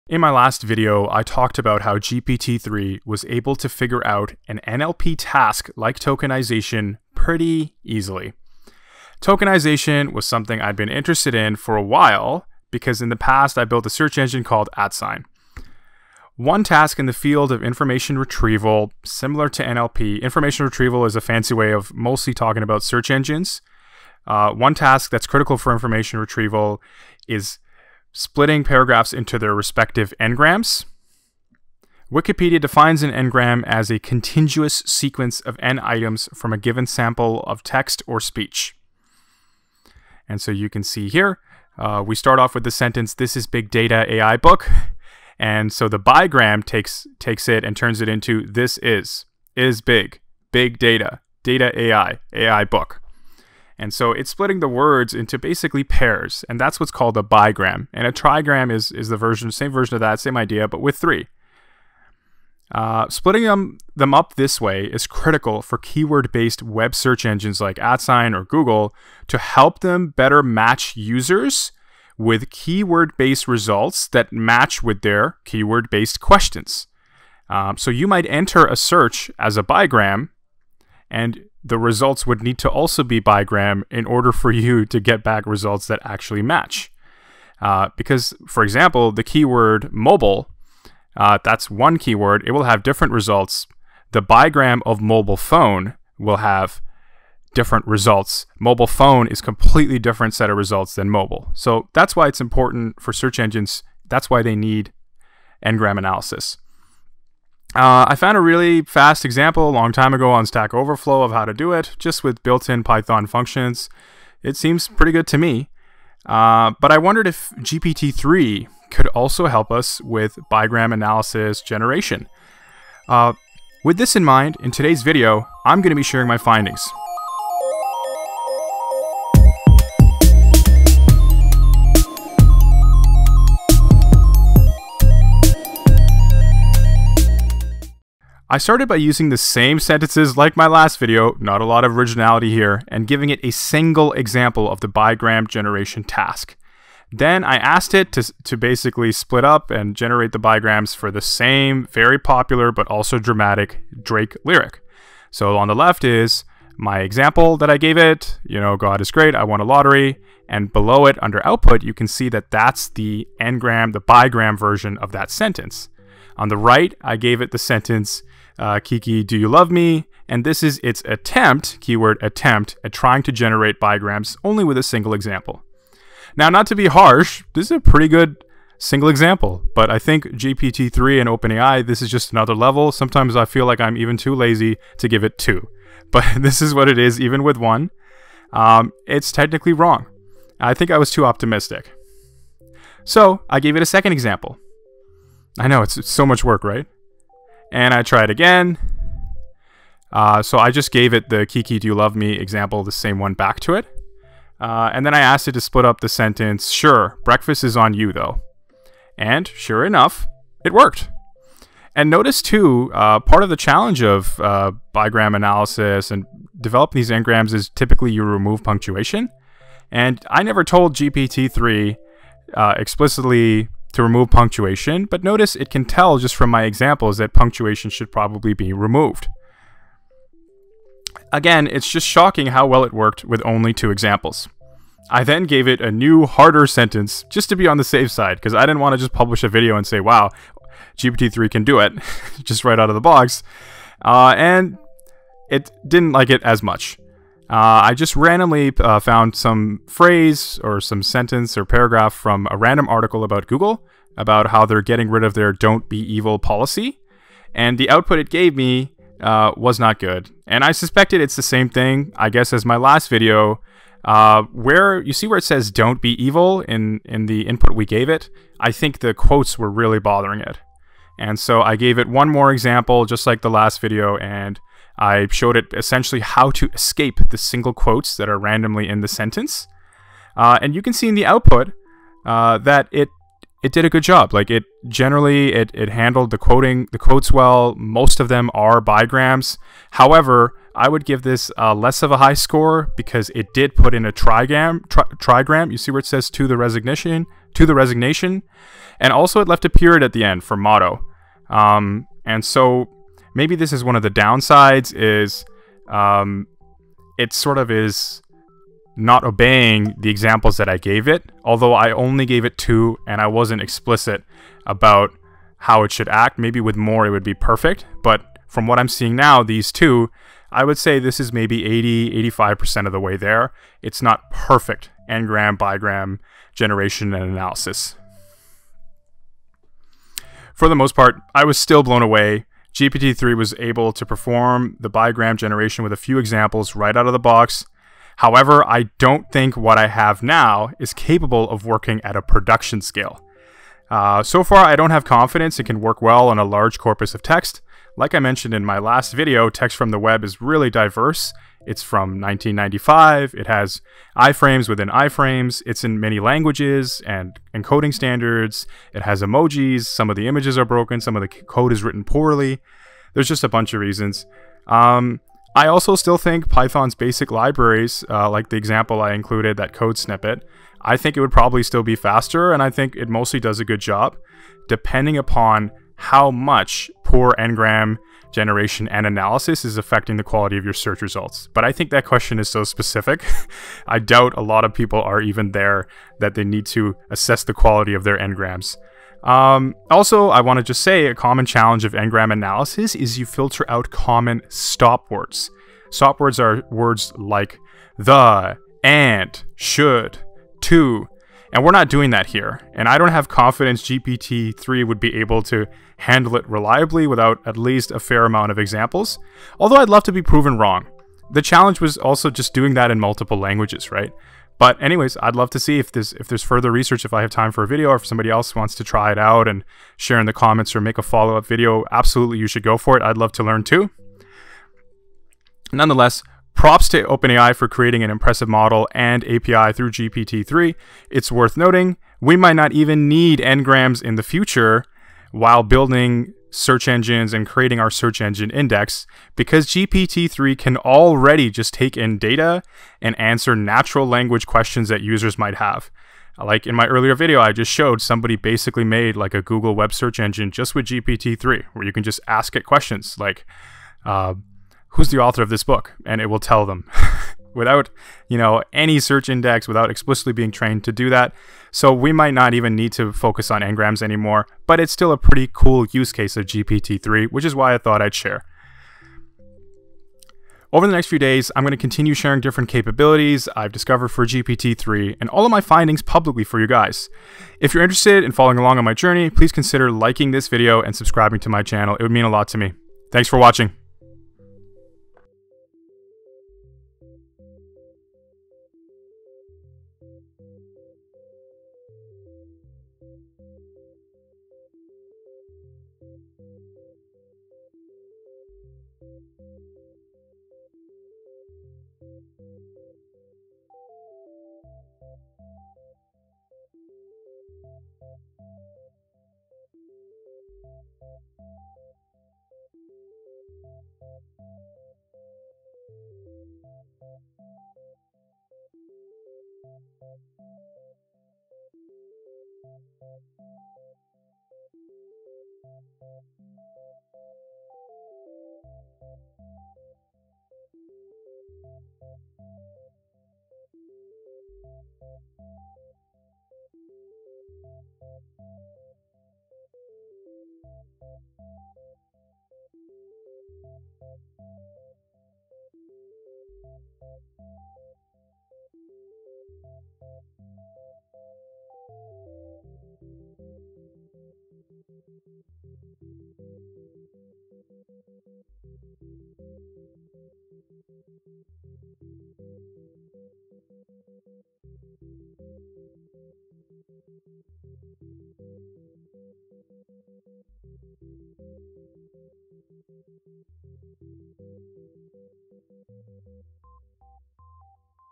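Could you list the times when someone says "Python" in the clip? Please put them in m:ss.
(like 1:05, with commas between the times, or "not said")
1:52, 6:06.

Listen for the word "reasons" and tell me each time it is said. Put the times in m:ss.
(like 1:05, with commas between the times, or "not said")
6:03.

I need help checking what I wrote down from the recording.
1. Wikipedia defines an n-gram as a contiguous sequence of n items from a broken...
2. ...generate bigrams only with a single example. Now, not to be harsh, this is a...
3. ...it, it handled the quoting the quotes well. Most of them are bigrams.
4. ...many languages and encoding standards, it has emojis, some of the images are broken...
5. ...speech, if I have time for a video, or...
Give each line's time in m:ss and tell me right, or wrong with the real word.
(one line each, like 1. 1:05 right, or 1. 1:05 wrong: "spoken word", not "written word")
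1. 0:32 wrong: "given", not "broken"
2. 2:53 right
3. 4:45 right
4. 5:55 right
5. 6:56 wrong: "research", not "speech".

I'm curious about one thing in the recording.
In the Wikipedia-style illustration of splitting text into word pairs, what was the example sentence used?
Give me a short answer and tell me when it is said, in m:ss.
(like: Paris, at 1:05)
This is big data AI book, at 0:43.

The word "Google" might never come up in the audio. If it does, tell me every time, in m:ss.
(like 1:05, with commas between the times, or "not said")
1:08, 4:13, 7:29.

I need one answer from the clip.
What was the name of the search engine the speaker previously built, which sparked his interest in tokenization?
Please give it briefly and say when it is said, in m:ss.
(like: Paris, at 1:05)
Atsign, at 0:14.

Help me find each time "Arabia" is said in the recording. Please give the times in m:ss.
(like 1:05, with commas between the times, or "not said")
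not said.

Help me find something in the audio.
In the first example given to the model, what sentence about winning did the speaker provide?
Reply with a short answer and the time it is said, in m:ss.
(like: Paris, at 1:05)
God is great, I won a lottery, at 2:38.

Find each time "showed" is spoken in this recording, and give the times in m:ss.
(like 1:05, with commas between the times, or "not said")
4:35, 7:27.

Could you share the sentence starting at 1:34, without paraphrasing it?
The bigram of mobile phone will have different results.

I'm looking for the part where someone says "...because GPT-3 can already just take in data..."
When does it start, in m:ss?
7:19.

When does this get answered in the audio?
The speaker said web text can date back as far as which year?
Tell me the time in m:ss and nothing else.
5:52.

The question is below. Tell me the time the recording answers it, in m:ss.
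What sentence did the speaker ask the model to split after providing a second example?
3:26.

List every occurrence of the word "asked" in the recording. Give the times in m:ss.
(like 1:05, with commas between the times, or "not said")
2:27, 3:25.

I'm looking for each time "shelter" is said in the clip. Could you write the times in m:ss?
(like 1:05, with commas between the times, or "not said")
not said.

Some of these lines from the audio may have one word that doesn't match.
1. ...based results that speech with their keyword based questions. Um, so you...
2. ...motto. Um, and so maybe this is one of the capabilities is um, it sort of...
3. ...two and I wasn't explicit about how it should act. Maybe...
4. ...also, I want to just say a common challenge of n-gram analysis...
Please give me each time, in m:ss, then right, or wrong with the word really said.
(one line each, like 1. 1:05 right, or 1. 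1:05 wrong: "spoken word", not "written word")
1. 1:13 wrong: "match", not "speech"
2. 5:00 wrong: "downsides", not "capabilities"
3. 5:12 right
4. 6:29 right.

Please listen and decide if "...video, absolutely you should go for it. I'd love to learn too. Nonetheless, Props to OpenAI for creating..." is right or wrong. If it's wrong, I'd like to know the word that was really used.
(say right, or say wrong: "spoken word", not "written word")
right.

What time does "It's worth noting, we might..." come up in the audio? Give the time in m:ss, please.
7:11.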